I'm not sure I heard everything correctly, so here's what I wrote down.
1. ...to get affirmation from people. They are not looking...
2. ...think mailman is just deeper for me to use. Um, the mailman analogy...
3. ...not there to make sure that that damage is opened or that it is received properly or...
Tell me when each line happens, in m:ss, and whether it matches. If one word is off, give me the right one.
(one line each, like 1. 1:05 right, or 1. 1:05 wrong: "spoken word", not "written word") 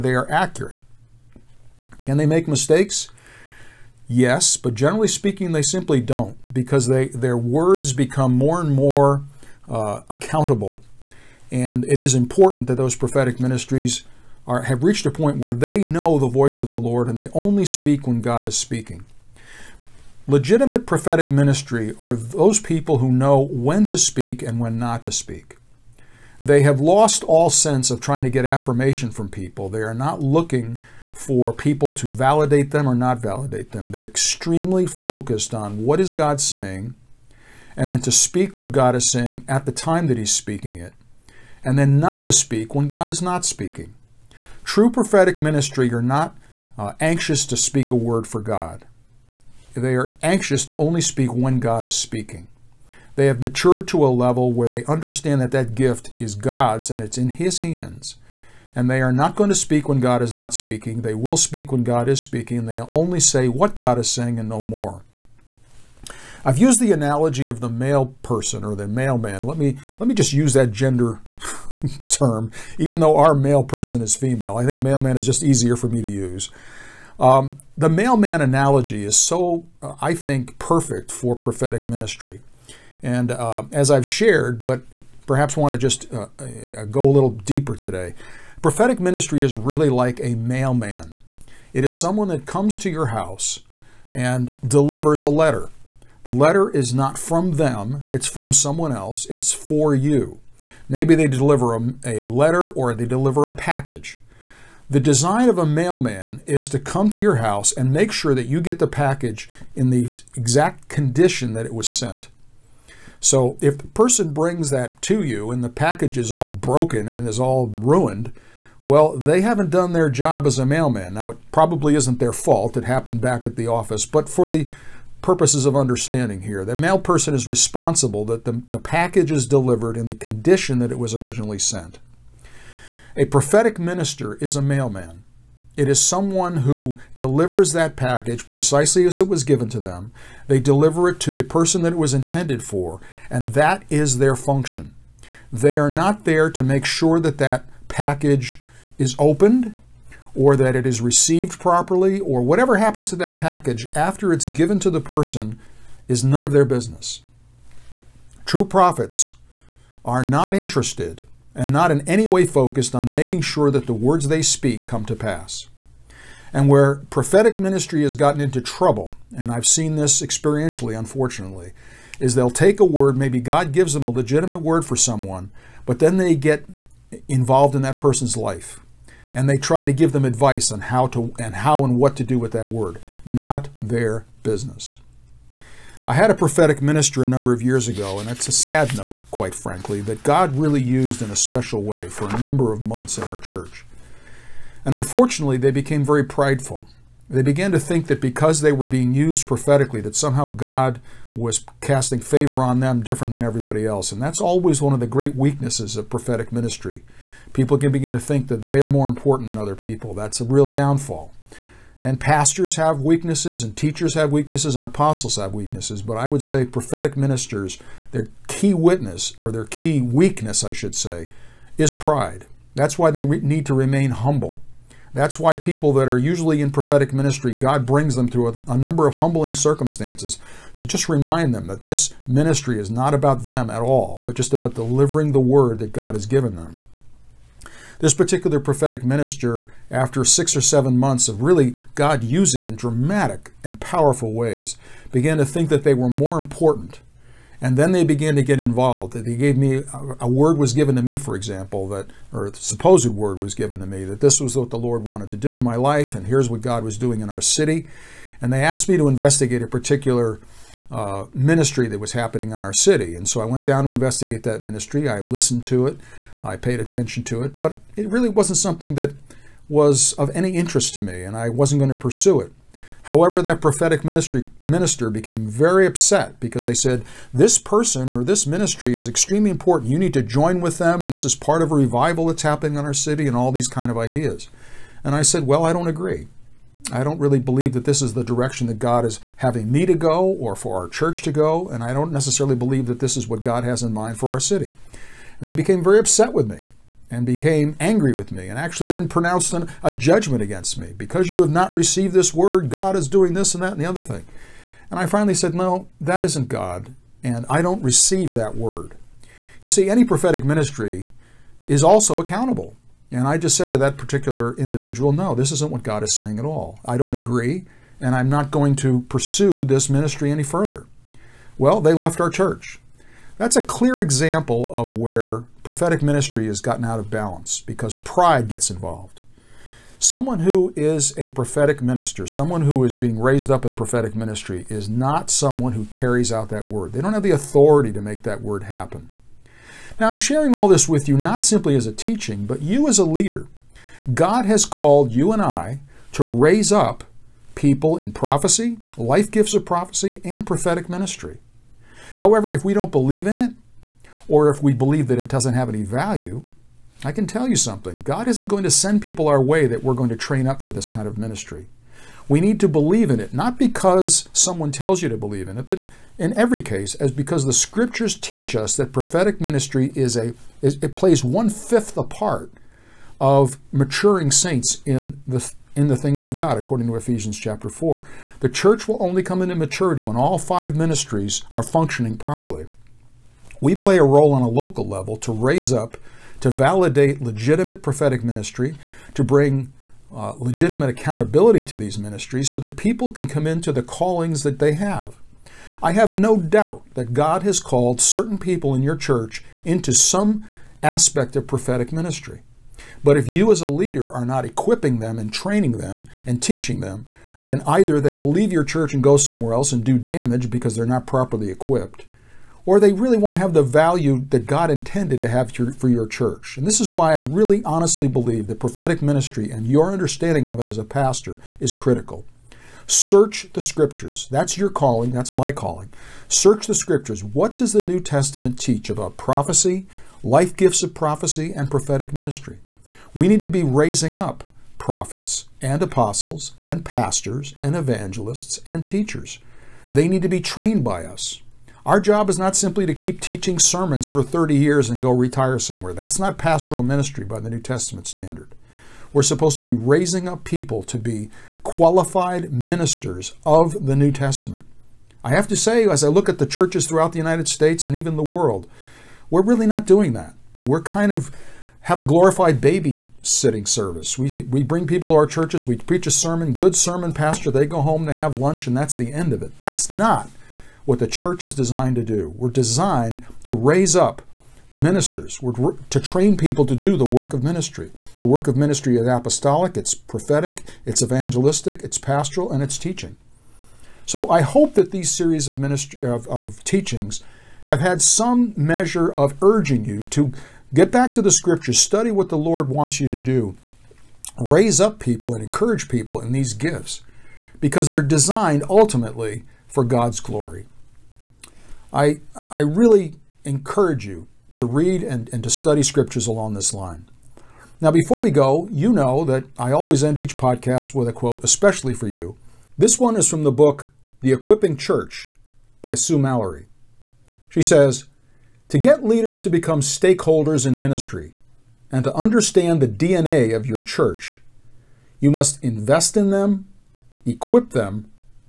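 1. 0:28 right
2. 1:14 wrong: "easier", not "deeper"
3. 2:25 wrong: "package", not "damage".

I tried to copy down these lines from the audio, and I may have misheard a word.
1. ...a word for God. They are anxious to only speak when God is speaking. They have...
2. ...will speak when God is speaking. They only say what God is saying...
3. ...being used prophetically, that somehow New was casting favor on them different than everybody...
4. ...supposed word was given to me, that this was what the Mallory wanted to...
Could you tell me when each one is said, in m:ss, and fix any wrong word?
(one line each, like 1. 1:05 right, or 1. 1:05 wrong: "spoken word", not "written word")
1. 0:47 right
2. 1:01 right
3. 3:18 wrong: "God", not "New"
4. 4:12 wrong: "Lord", not "Mallory".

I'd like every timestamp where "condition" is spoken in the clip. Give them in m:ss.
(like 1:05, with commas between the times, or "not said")
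1:50, 2:10.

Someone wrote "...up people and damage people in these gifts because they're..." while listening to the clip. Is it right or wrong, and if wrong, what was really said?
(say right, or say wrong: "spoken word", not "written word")
wrong: "encourage", not "damage".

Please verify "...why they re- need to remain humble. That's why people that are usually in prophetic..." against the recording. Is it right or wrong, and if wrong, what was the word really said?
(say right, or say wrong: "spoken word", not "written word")
right.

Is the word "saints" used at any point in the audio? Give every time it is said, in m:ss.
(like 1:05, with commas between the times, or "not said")
6:14.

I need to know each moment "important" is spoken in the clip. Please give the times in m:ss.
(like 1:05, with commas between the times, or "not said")
0:12, 3:29, 4:06, 4:39.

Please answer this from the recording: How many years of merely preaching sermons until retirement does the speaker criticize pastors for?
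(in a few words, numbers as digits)
30.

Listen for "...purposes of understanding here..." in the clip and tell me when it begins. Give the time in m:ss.
2:05.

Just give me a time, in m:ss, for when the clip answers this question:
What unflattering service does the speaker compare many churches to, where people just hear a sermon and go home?
7:42.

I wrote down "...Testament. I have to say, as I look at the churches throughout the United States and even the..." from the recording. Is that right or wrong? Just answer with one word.
right.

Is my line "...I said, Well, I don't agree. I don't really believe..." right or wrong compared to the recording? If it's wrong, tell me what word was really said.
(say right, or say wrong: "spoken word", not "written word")
right.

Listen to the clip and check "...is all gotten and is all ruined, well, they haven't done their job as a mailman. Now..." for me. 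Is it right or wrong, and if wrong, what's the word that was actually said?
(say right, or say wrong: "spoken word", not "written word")
wrong: "broken", not "gotten".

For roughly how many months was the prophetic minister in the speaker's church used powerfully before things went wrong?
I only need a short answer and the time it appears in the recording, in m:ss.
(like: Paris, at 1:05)
6 or 7, at 4:00.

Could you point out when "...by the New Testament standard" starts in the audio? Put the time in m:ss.
7:27.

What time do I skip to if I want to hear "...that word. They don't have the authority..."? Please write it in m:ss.
5:36.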